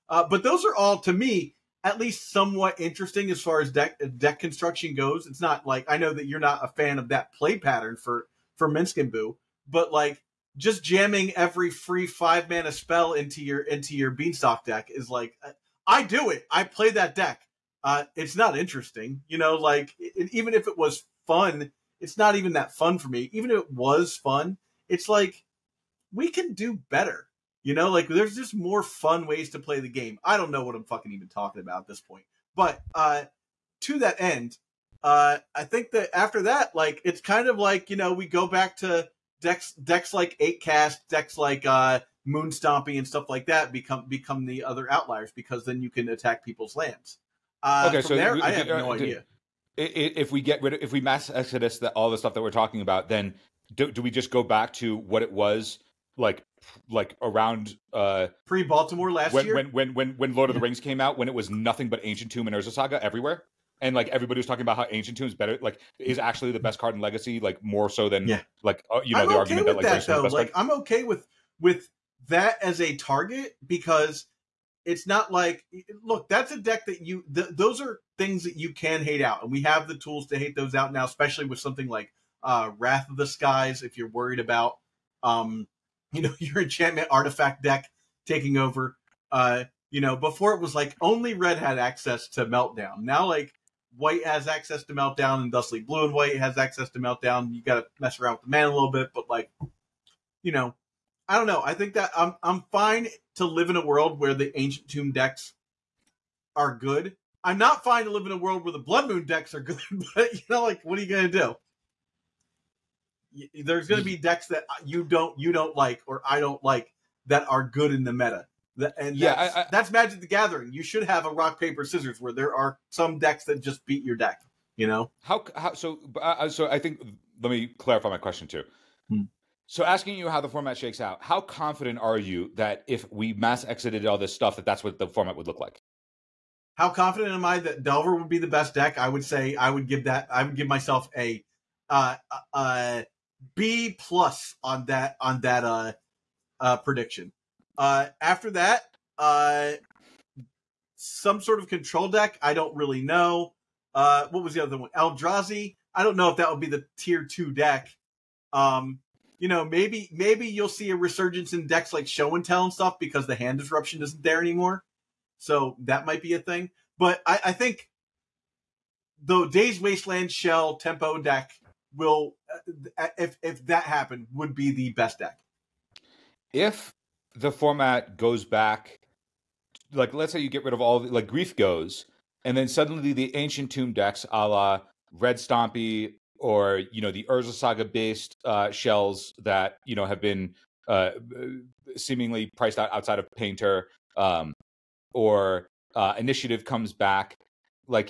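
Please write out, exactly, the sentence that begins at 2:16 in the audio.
How confident am I that Delver would be the best deck?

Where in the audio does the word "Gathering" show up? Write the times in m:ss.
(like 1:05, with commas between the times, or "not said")
2:00.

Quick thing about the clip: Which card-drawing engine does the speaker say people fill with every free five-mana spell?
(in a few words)
Beanstalk.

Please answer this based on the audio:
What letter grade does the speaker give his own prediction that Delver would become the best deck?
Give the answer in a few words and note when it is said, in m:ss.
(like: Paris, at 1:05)
B plus, at 2:23.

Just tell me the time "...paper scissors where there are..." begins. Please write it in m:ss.
2:01.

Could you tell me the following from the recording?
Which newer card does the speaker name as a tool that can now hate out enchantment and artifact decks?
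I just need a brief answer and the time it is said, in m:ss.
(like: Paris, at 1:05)
Wrath of the Skies, at 1:22.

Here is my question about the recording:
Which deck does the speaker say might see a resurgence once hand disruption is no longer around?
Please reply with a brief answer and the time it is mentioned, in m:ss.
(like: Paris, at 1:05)
Show and Tell, at 2:42.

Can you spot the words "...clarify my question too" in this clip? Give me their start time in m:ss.
2:07.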